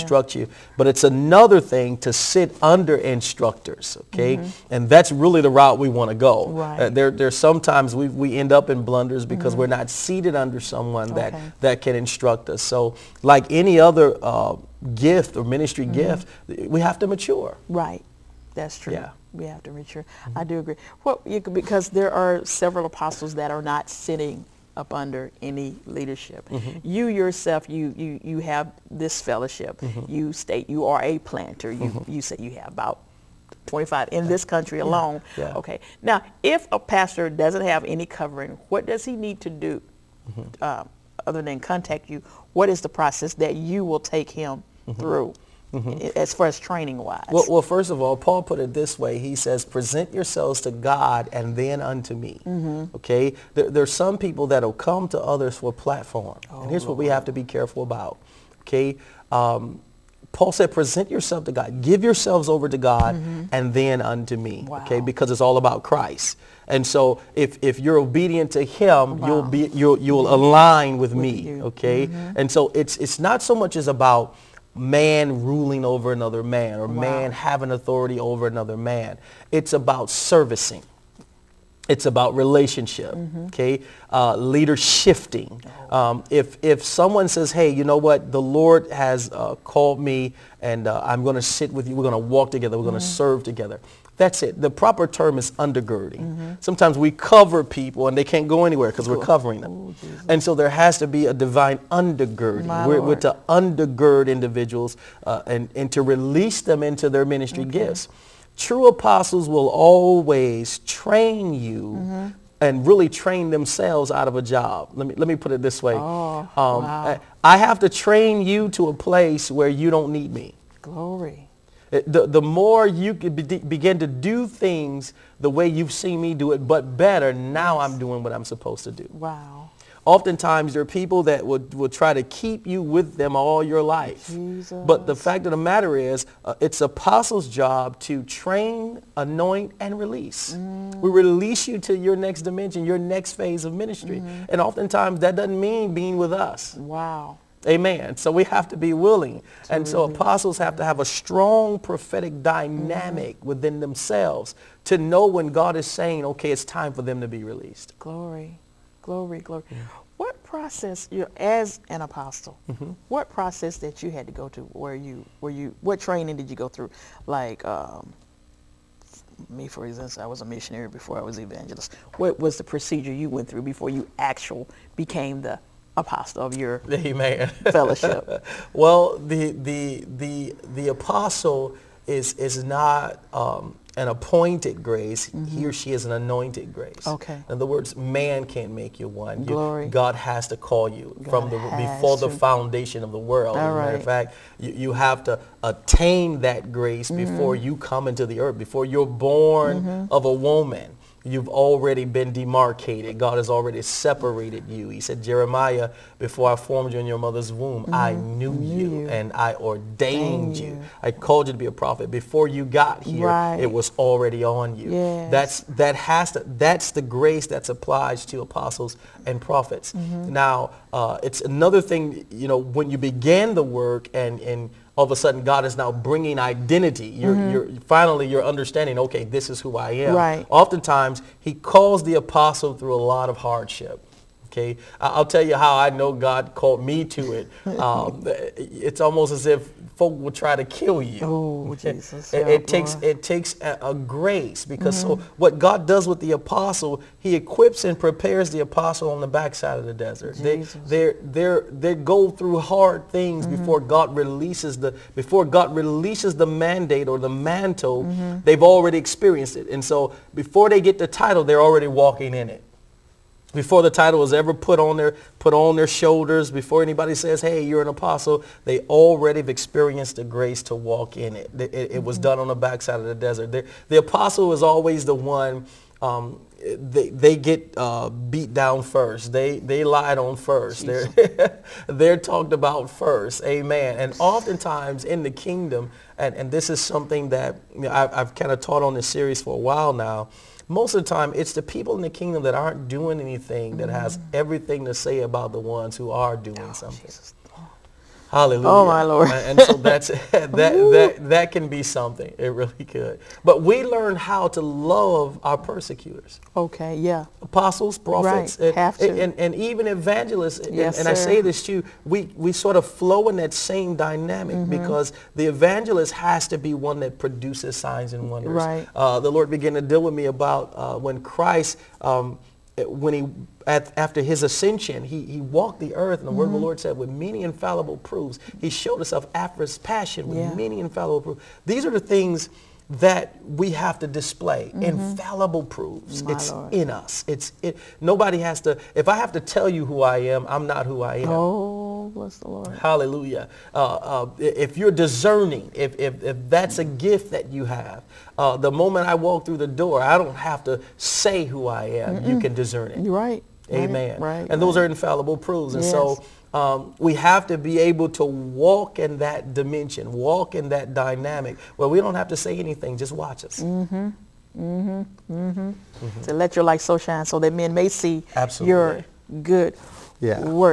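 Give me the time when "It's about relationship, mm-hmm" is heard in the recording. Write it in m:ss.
1:21.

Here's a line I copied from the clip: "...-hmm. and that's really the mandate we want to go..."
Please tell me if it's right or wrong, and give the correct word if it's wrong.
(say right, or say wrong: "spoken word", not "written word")
wrong: "route", not "mandate".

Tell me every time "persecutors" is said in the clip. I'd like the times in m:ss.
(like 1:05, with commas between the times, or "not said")
5:05.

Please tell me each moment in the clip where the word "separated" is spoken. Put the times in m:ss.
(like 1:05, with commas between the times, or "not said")
3:23.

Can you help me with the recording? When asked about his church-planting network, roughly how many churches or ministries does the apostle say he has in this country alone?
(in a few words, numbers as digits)
25.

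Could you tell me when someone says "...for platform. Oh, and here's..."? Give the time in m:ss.
0:55.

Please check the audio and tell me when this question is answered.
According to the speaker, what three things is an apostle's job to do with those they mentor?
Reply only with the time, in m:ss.
2:18.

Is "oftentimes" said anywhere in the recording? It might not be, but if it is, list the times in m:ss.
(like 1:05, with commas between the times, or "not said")
2:10, 2:24, 3:50, 4:44.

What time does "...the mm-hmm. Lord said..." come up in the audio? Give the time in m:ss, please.
5:26.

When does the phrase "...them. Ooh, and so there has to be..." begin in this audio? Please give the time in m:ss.
1:39.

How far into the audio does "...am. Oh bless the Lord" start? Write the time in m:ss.
5:41.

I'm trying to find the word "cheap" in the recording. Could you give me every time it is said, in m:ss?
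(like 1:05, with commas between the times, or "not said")
not said.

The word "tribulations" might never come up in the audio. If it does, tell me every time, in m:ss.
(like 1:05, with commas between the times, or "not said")
not said.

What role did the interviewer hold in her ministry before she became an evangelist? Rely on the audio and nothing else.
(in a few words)
Missionary.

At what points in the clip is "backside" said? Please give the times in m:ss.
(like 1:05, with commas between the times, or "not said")
4:09, 4:32.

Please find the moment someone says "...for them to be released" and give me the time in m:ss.
2:36.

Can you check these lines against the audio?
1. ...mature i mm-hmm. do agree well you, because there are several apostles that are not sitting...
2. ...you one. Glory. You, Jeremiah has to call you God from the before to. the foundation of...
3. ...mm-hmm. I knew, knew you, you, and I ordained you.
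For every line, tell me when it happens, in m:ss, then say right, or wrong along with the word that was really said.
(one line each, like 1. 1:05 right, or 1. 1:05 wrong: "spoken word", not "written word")
1. 0:19 right
2. 3:09 wrong: "God", not "Jeremiah"
3. 3:27 right.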